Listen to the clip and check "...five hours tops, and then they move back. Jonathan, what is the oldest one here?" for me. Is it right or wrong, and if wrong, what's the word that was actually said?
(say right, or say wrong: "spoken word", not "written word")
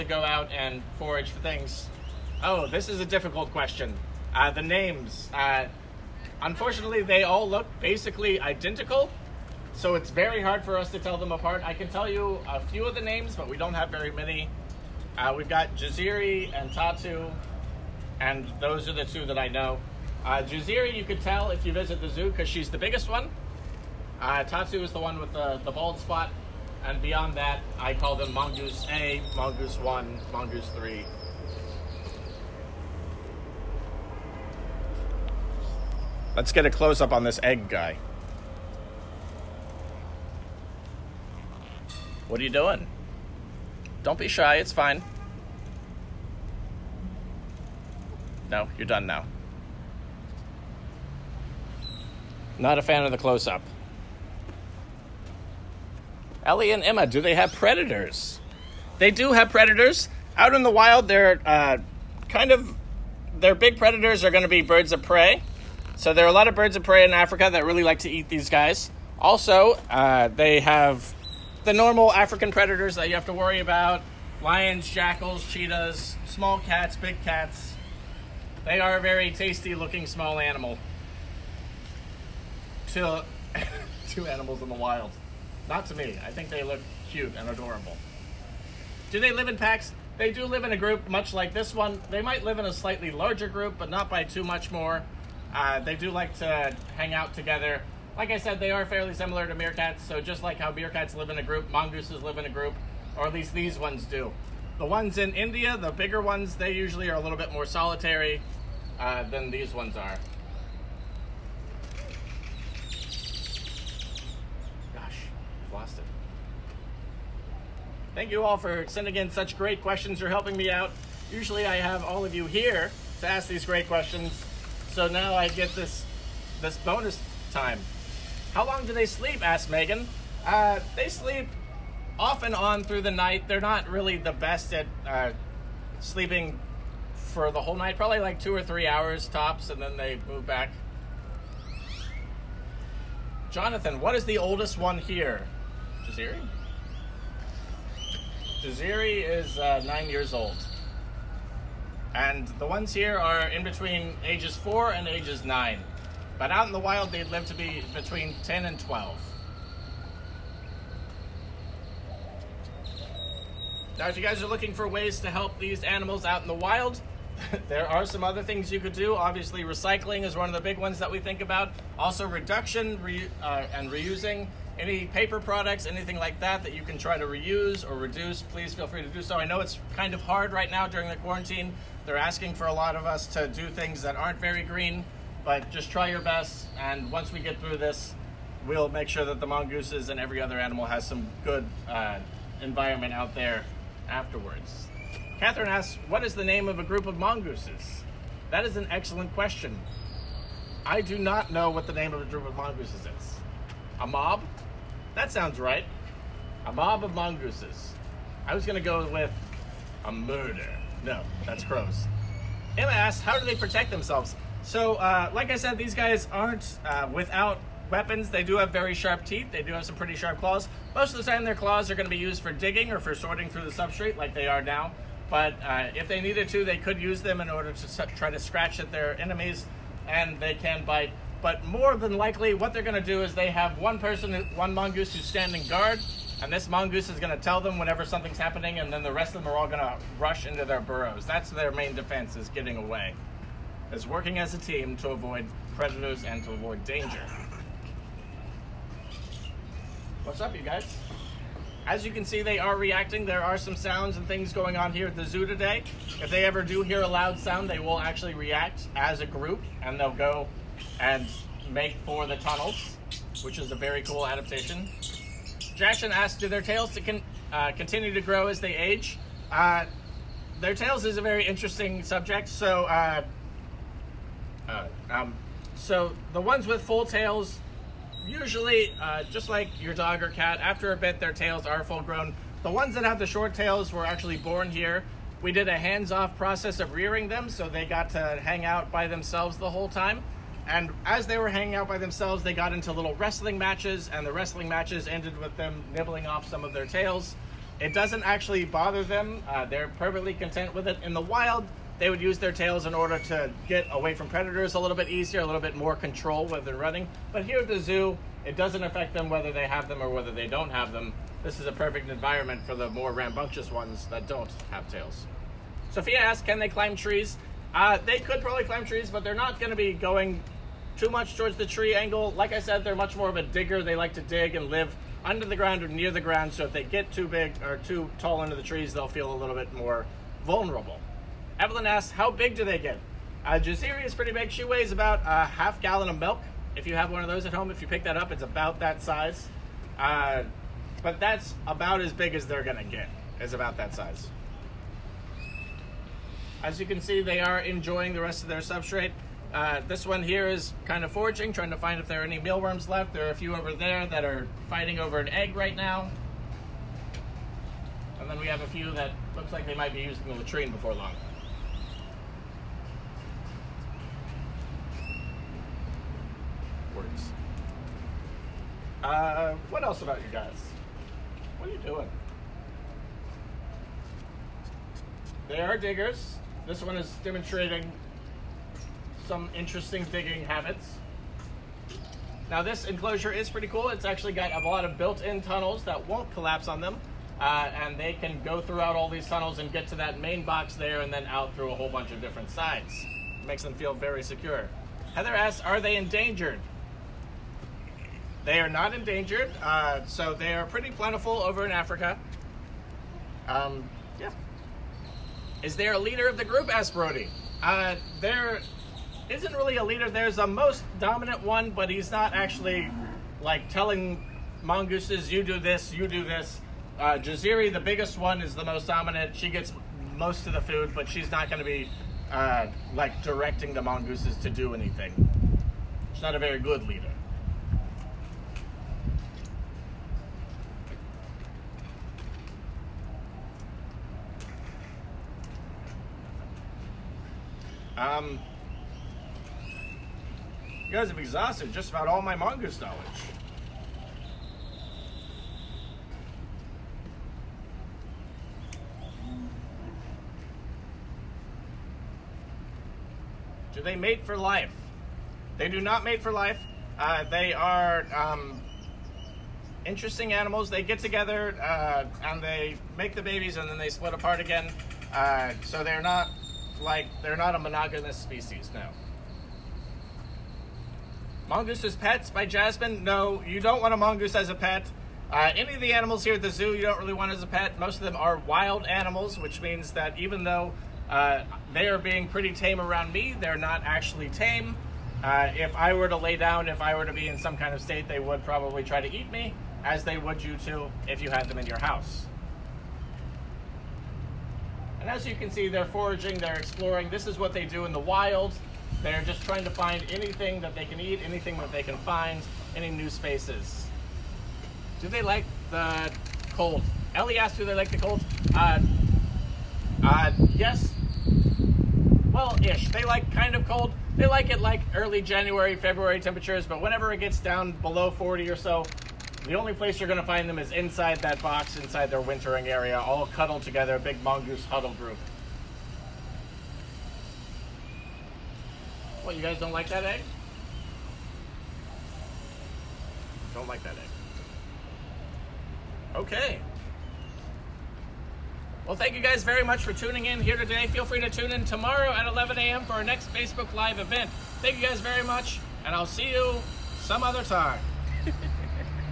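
wrong: "three", not "five".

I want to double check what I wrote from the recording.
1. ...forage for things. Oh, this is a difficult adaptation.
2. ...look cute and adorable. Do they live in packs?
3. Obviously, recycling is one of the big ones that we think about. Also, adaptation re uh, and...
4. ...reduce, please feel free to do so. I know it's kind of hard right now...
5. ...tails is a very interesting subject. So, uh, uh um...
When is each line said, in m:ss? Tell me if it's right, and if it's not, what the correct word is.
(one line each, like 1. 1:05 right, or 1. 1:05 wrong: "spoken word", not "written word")
1. 0:00 wrong: "question", not "adaptation"
2. 1:26 right
3. 2:49 wrong: "reduction", not "adaptation"
4. 2:57 right
5. 4:30 right.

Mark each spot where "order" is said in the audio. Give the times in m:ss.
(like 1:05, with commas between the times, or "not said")
3:47, 5:02.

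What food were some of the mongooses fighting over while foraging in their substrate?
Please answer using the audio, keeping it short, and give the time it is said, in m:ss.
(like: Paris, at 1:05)
An egg, at 5:55.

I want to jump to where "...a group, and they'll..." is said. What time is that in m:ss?
4:19.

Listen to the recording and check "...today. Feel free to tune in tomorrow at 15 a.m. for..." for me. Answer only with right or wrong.
wrong.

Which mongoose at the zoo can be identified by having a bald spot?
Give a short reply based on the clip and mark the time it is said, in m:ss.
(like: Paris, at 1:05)
Tatu, at 0:24.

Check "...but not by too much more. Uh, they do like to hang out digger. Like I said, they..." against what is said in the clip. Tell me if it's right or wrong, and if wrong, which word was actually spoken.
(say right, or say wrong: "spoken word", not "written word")
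wrong: "together", not "digger".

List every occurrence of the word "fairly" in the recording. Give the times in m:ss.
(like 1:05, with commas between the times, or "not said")
1:38.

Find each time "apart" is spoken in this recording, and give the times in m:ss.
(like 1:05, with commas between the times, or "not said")
0:11, 7:44.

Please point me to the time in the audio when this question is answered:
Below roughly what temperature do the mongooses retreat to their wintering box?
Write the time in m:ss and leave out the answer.
8:38.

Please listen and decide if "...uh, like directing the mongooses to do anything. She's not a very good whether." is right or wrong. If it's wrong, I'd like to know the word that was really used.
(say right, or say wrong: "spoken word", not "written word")
wrong: "leader", not "whether".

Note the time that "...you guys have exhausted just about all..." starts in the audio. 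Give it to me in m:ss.
7:20.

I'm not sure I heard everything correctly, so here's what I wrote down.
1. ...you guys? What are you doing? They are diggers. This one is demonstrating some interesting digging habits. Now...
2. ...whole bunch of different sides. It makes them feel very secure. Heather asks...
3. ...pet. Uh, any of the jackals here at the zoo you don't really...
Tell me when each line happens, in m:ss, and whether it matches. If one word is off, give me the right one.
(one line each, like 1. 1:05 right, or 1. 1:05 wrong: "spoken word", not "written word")
1. 6:10 right
2. 6:31 right
3. 7:54 wrong: "animals", not "jackals".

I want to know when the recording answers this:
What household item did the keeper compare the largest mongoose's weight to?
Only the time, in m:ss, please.
5:35.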